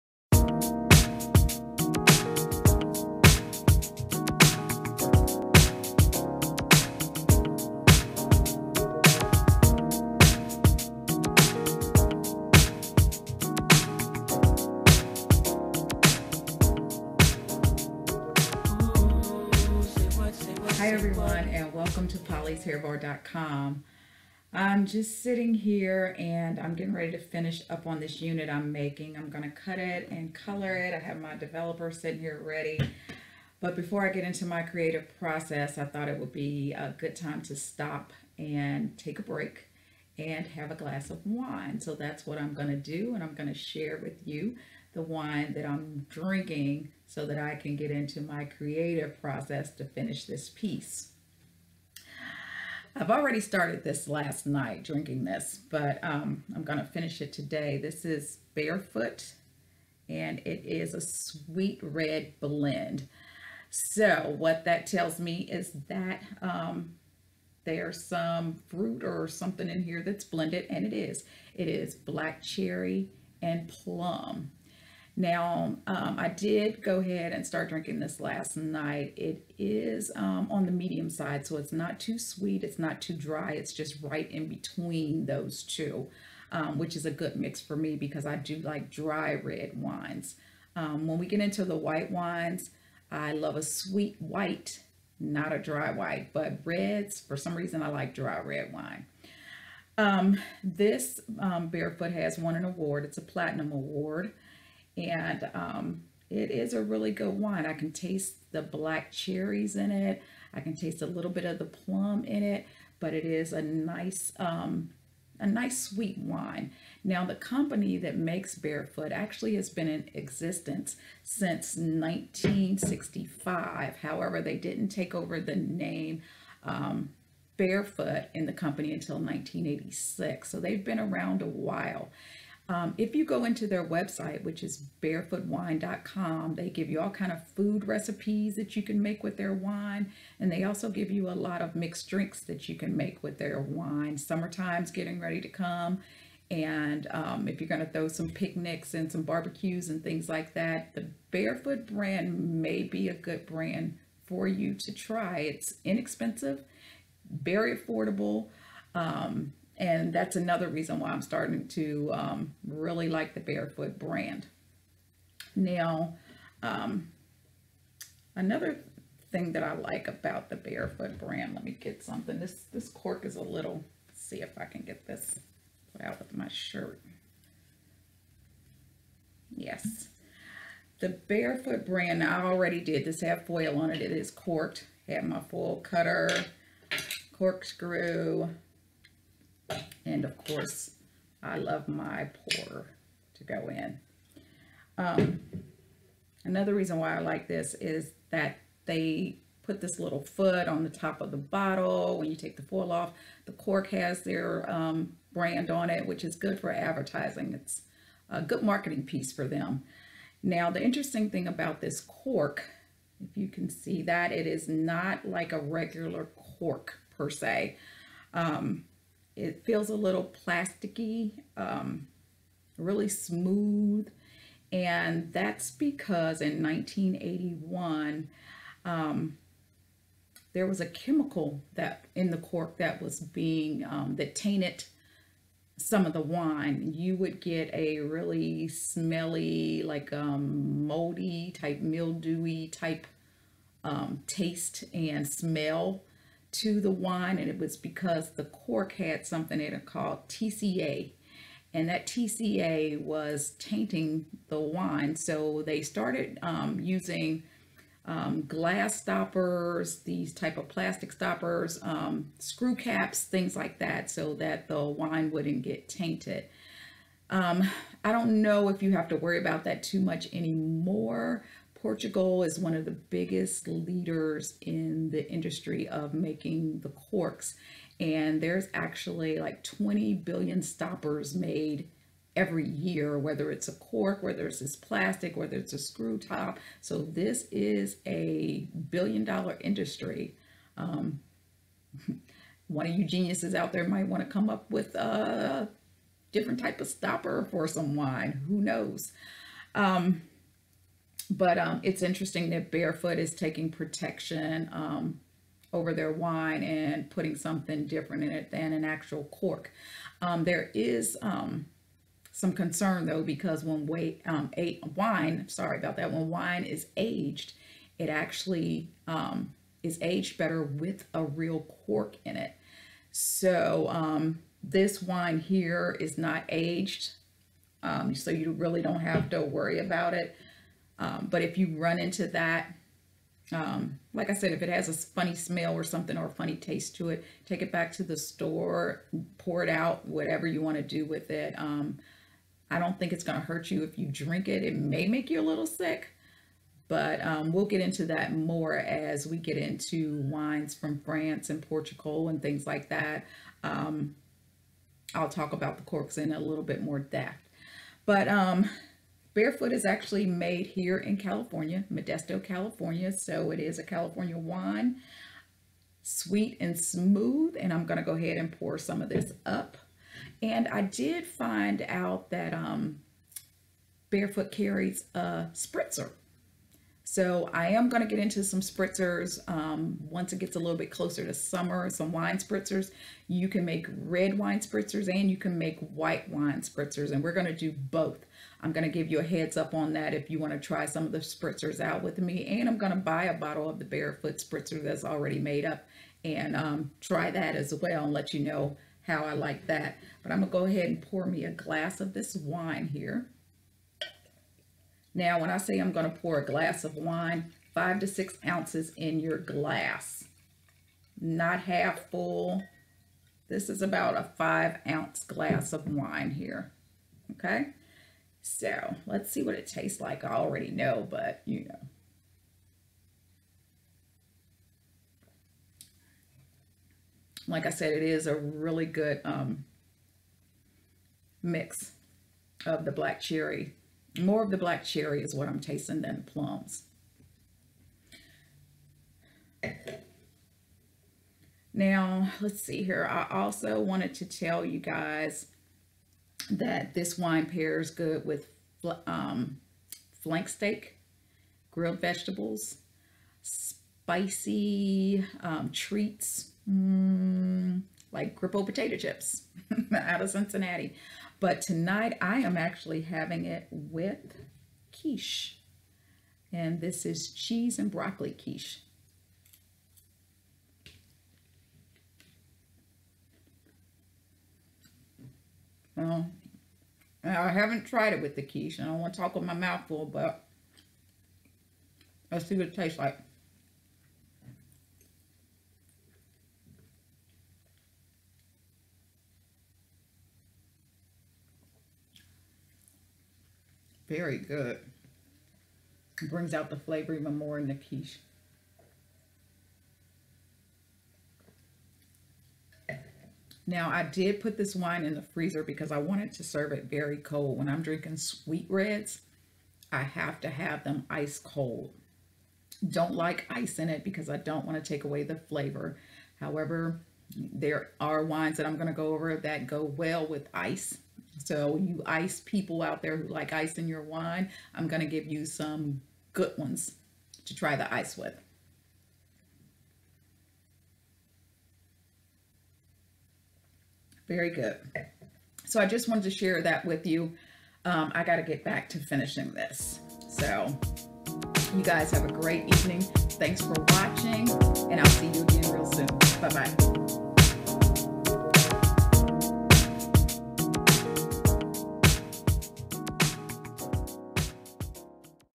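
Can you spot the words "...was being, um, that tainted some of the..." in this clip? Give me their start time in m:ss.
3:53.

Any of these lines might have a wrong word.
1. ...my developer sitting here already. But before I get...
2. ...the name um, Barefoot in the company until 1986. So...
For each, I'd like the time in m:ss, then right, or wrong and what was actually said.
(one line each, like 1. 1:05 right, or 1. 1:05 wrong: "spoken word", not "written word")
1. 0:31 wrong: "ready", not "already"
2. 2:05 right.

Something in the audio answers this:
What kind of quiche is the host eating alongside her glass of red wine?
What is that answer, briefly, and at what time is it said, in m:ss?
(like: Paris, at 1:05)
Cheese and broccoli, at 7:47.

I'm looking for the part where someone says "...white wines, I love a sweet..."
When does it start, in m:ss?
1:31.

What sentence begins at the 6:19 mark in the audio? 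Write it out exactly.
Um, once it gets a little bit closer to summer, some wine spritzers.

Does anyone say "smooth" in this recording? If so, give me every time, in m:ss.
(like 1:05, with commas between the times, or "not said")
3:43, 6:06.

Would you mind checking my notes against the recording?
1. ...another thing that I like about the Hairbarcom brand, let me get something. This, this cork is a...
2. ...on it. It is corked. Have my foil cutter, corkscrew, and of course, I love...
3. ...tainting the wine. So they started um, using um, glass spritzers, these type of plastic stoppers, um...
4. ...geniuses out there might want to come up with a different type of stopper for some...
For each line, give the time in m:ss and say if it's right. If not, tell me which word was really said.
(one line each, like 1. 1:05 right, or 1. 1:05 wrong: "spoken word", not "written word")
1. 2:48 wrong: "Barefoot", not "Hairbarcom"
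2. 3:03 right
3. 4:13 wrong: "stoppers", not "spritzers"
4. 4:53 right.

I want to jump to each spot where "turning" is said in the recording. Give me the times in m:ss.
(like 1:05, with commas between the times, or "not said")
not said.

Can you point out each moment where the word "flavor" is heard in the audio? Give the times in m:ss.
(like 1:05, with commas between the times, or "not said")
8:16, 8:35.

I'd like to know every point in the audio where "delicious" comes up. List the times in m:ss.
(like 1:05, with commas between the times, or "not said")
not said.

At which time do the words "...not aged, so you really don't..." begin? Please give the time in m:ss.
5:26.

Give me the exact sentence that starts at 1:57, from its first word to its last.
Now, the company that makes Barefoot actually has been in existence since 1965.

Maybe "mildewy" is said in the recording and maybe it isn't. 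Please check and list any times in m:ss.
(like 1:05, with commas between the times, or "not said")
4:01.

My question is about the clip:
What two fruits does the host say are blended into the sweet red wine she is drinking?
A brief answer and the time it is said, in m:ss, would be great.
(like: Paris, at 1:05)
Black cherry and plum, at 1:11.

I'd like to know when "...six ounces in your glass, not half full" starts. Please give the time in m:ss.
6:48.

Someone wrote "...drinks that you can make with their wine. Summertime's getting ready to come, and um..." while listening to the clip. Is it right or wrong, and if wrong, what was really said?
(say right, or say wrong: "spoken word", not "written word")
right.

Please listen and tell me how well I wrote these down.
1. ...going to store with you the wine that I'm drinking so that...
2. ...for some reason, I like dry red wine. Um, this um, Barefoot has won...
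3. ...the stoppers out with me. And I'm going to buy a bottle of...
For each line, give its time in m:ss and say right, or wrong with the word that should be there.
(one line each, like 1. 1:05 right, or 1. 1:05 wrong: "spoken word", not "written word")
1. 0:43 wrong: "share", not "store"
2. 1:37 right
3. 6:31 wrong: "spritzers", not "stoppers".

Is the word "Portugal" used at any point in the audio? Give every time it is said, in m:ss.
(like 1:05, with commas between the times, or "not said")
4:31, 5:51.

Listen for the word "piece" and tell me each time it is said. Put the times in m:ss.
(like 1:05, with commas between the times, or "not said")
0:50, 3:29.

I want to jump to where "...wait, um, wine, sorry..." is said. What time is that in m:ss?
5:13.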